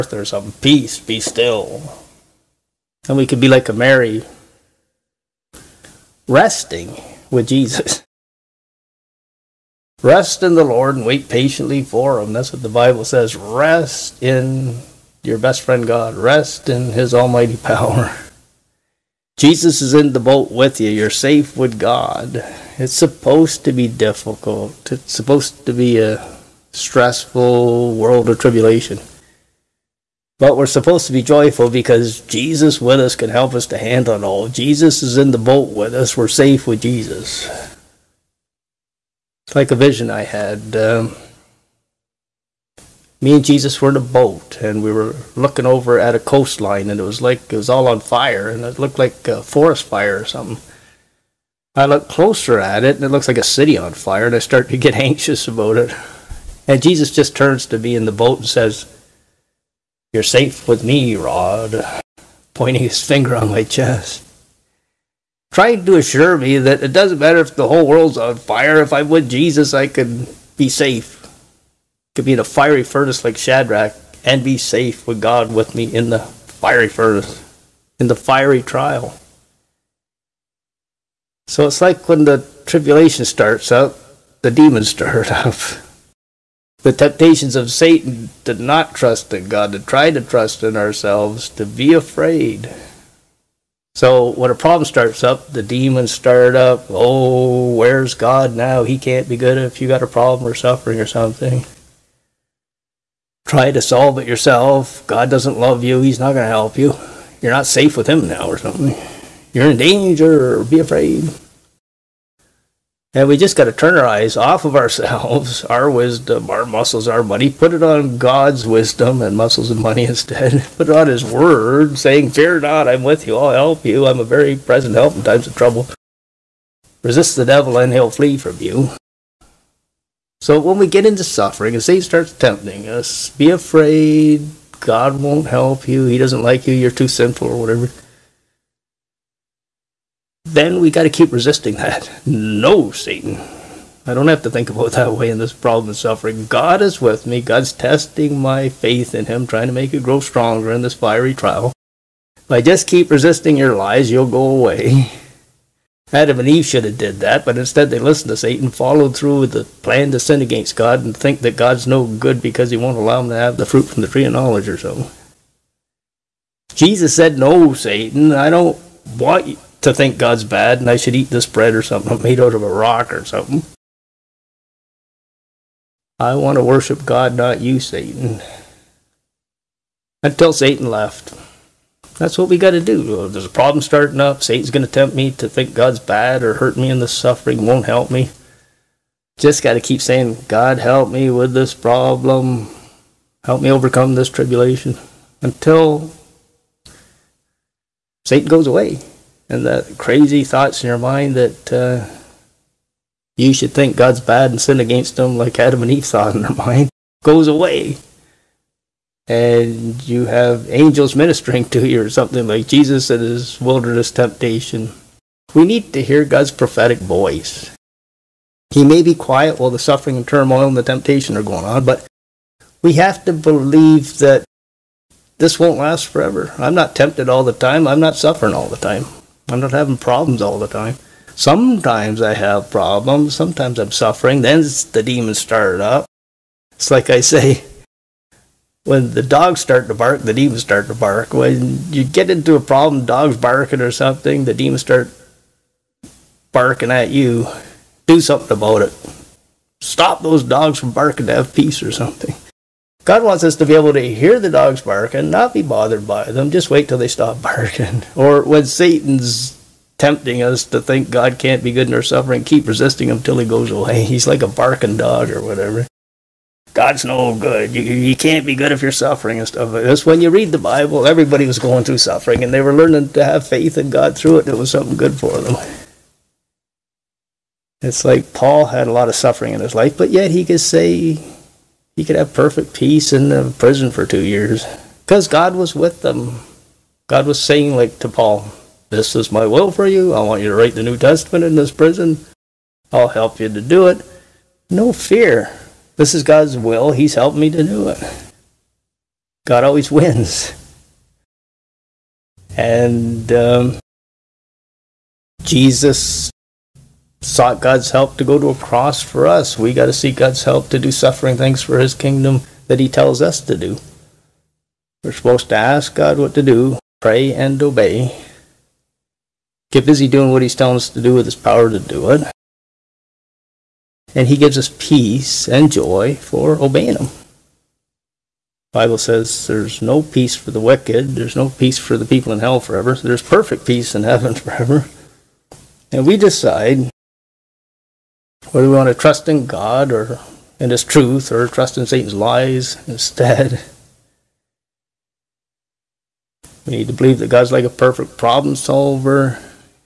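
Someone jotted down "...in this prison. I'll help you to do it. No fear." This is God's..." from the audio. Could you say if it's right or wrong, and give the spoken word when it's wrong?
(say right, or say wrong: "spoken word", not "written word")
right.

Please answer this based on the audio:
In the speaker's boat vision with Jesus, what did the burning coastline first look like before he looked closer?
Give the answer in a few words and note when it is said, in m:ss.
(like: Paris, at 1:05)
a forest fire, at 0:49.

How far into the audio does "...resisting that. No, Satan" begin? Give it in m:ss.
2:21.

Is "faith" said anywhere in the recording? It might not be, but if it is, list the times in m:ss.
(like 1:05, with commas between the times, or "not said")
2:28, 4:33.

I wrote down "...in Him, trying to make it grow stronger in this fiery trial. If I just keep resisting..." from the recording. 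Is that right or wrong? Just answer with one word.
right.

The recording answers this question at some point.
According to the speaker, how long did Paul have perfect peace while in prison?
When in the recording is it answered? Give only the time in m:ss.
4:44.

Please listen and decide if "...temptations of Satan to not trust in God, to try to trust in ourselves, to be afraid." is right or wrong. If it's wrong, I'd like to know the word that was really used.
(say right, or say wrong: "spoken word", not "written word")
right.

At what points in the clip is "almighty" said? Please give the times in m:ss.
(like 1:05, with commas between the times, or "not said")
0:17.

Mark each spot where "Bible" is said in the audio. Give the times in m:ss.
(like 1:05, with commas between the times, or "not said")
0:12, 4:30, 5:28.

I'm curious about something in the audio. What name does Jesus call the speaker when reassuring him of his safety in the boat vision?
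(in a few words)
Rod.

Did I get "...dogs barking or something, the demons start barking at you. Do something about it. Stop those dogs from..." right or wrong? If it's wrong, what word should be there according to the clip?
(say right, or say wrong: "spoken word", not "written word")
right.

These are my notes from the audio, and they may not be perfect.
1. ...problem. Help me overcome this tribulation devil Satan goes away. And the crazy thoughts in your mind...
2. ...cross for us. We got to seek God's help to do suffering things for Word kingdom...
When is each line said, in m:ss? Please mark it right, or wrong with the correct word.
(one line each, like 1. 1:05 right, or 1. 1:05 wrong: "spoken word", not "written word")
1. 3:11 wrong: "until", not "devil"
2. 5:08 wrong: "His", not "Word".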